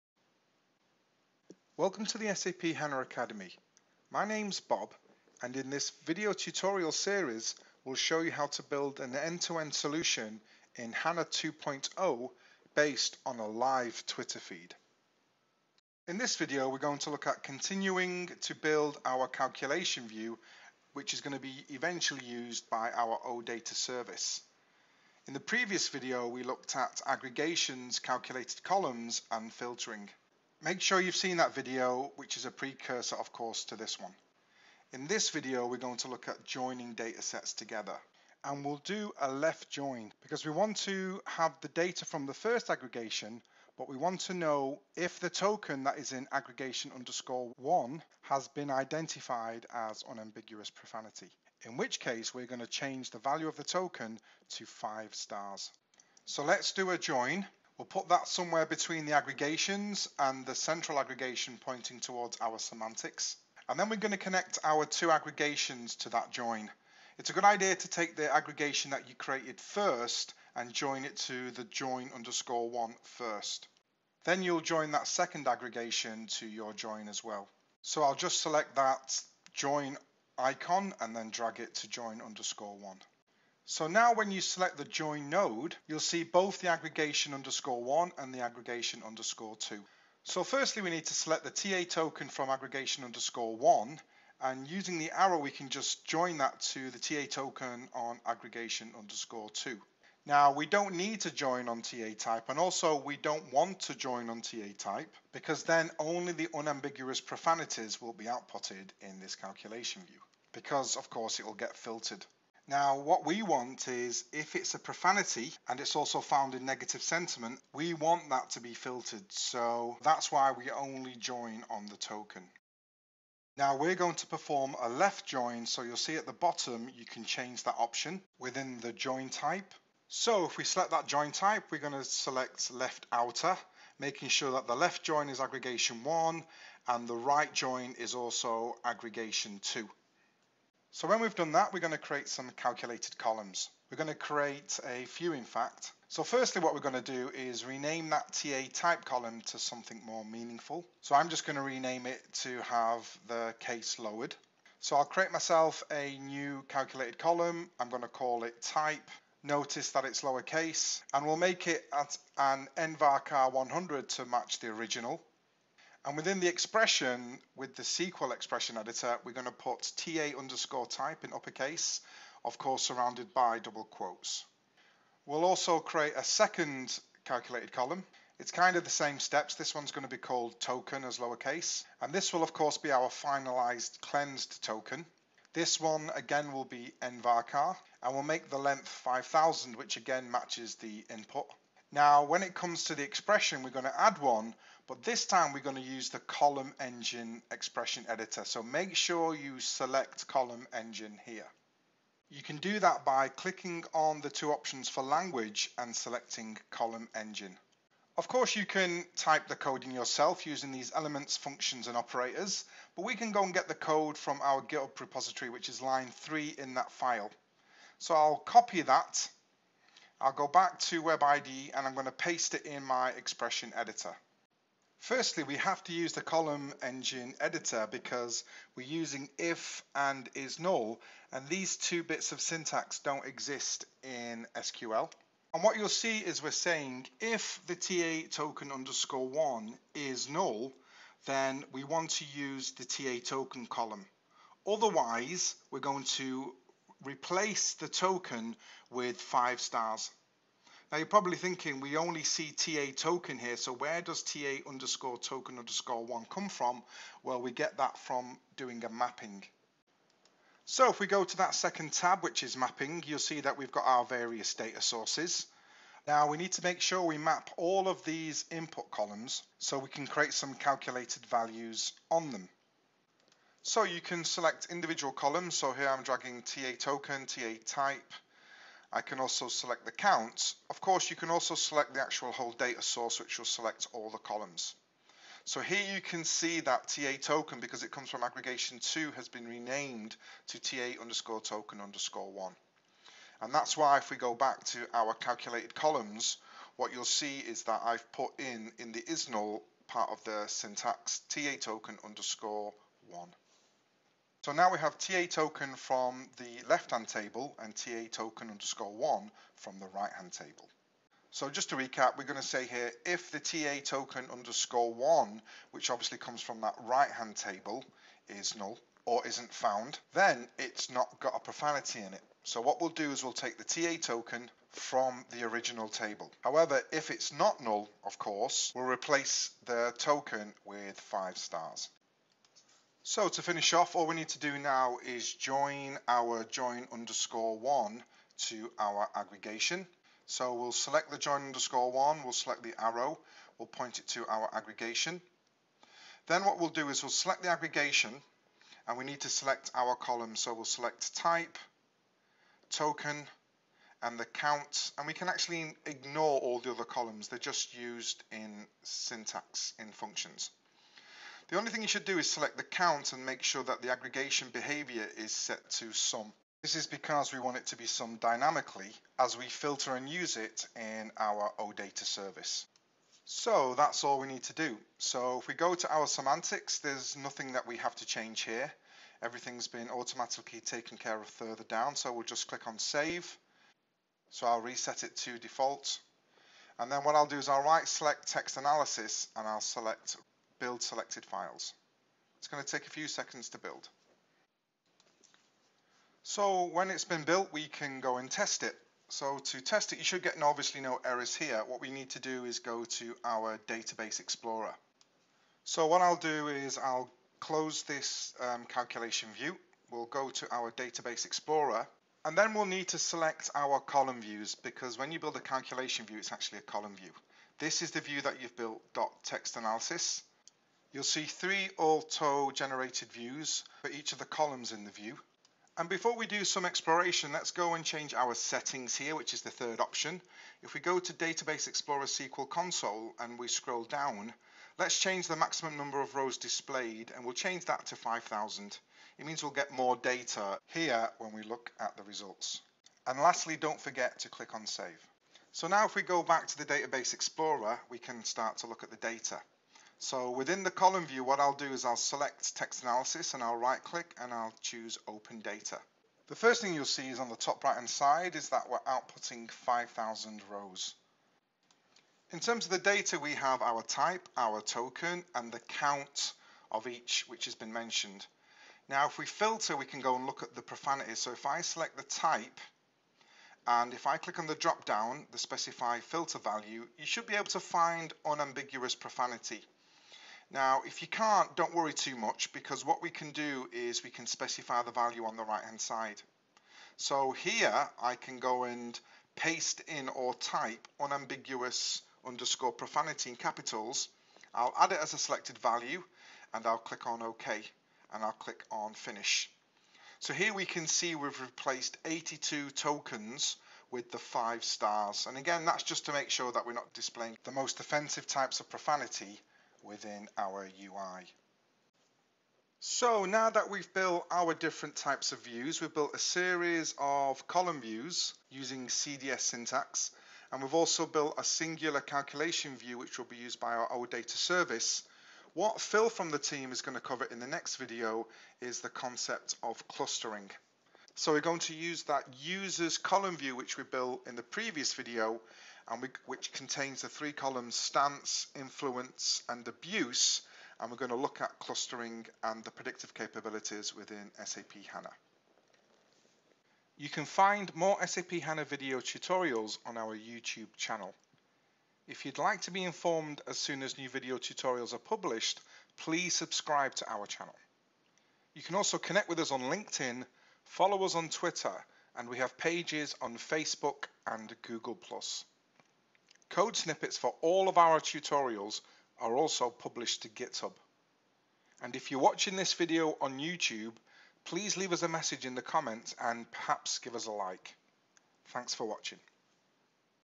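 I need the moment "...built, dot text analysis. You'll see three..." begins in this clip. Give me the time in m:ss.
6:58.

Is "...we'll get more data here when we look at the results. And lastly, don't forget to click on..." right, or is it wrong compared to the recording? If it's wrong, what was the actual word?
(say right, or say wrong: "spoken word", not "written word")
right.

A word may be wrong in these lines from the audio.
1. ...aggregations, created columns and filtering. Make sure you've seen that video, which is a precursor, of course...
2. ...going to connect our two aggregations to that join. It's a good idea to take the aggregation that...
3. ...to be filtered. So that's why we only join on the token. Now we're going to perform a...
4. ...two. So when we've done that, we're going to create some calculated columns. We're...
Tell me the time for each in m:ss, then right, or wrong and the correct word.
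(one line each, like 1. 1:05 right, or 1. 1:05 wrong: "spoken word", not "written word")
1. 0:27 wrong: "calculated", not "created"
2. 1:03 right
3. 1:58 right
4. 2:19 right.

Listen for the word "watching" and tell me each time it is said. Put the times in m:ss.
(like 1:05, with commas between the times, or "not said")
9:32, 9:38.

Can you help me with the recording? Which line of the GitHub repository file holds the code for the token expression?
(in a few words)
line 3.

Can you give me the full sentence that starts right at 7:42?
In terms of the data, we have our type, our token, and the count of each which has been mentioned.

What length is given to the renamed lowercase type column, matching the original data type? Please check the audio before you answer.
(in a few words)
nvarchar 100.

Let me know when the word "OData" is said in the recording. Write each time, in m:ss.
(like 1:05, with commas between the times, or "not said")
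0:23, 6:11, 8:43.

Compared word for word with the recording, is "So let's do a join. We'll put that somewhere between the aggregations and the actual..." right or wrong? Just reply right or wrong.
wrong.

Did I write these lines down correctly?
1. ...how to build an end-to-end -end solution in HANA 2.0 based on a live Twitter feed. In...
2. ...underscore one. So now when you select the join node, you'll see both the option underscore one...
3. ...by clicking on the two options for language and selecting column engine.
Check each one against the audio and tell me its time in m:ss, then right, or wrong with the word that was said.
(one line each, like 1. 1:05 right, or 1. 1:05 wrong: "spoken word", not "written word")
1. 0:08 right
2. 1:22 wrong: "aggregation", not "option"
3. 3:23 right.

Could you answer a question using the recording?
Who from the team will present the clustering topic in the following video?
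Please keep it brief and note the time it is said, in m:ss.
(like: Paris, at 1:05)
Phil, at 8:45.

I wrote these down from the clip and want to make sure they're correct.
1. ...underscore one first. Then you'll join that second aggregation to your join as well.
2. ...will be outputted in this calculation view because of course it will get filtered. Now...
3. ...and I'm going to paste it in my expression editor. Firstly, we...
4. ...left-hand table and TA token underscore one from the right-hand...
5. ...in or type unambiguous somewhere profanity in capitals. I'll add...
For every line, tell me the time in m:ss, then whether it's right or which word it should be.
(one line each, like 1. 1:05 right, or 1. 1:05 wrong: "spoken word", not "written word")
1. 1:12 right
2. 1:48 right
3. 3:41 right
4. 5:06 right
5. 8:09 wrong: "underscore", not "somewhere".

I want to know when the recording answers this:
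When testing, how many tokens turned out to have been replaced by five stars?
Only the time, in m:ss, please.
8:22.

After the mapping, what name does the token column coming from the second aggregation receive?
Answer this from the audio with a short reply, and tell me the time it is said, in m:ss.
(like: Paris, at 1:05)
TA_TOKEN_1, at 4:50.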